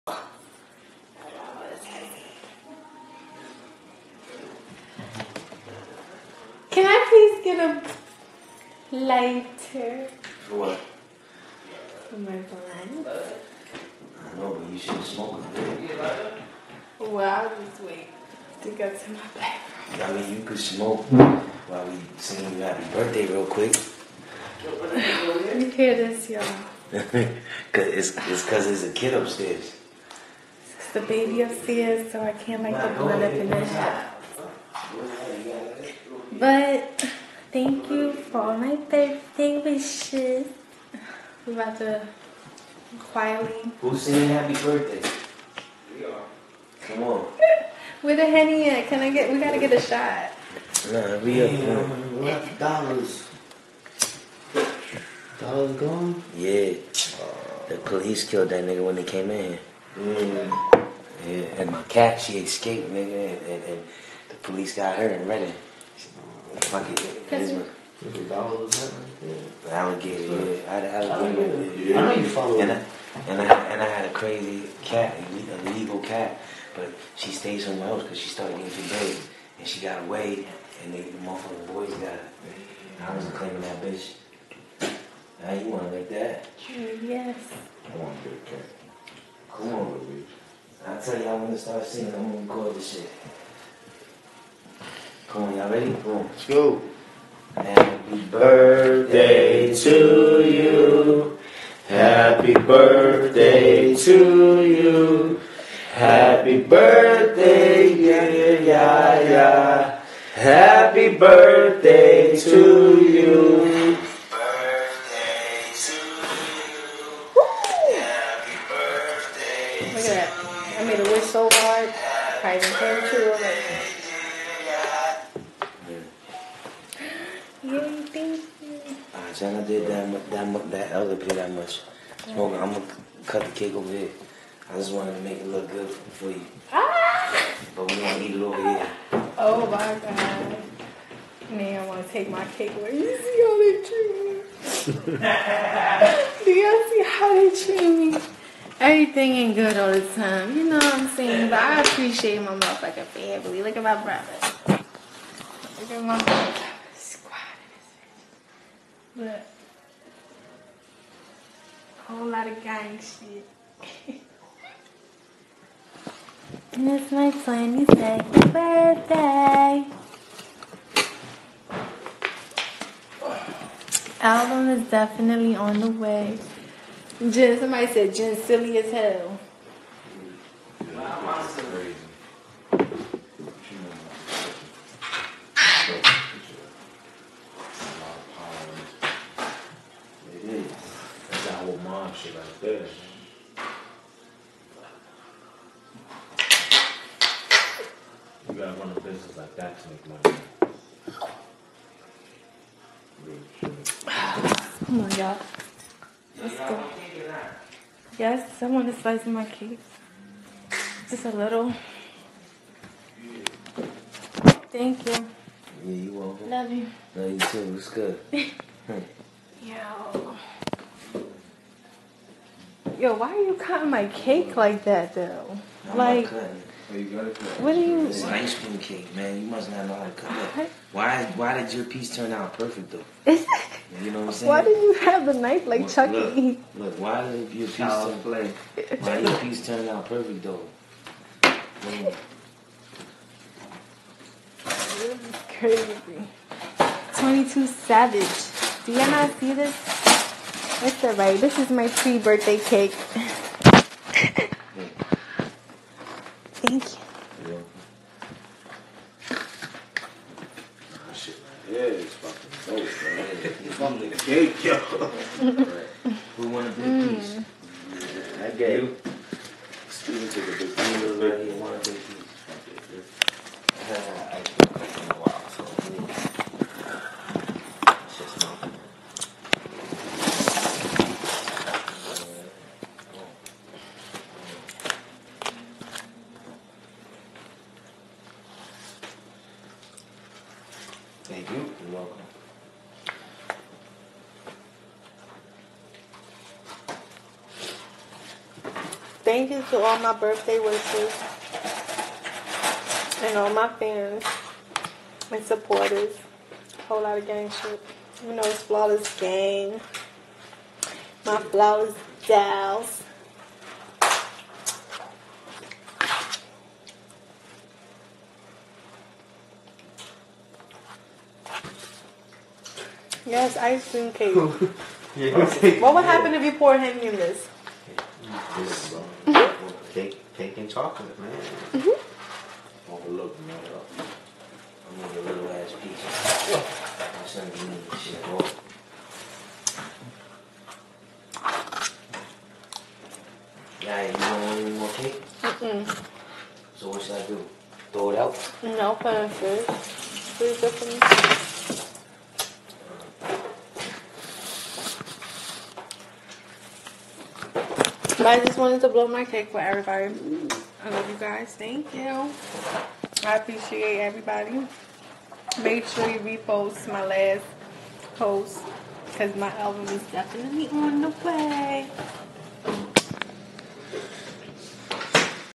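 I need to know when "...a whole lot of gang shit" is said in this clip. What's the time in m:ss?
2:42.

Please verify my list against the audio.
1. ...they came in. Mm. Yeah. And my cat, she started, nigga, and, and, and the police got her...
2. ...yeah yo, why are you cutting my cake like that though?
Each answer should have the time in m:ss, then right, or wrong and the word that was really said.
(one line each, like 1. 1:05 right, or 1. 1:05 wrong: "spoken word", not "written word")
1. 0:58 wrong: "escaped", not "started"
2. 3:39 right.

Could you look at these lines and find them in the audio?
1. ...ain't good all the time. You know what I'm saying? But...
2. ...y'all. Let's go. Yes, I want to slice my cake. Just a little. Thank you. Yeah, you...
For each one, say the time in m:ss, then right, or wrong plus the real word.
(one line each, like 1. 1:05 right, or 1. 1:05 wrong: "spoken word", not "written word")
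1. 2:29 right
2. 3:25 right.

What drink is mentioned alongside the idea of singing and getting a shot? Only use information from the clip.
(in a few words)
Henny.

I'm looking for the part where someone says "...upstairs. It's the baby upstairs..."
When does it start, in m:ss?
0:29.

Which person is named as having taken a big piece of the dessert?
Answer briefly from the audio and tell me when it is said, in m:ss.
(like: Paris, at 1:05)
Steven, at 4:29.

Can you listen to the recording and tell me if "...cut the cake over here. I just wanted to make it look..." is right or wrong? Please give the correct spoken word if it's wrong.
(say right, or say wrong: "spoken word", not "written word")
right.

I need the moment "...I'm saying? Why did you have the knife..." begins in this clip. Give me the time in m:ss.
3:54.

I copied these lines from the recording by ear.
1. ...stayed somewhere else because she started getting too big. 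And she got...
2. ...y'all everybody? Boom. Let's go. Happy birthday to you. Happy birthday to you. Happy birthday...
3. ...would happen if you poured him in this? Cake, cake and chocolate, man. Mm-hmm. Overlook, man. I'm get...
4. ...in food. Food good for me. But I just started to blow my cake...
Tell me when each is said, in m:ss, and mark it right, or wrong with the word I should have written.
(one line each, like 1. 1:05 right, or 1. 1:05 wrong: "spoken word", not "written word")
1. 1:17 right
2. 1:35 wrong: "ready", not "everybody"
3. 5:25 right
4. 5:49 wrong: "wanted", not "started".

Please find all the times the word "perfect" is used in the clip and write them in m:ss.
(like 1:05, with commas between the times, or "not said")
3:52, 4:00.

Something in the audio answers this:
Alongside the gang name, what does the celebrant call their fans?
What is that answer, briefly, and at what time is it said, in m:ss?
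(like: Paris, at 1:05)
Flawless dolls, at 5:11.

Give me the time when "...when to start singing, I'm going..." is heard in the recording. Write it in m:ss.
1:31.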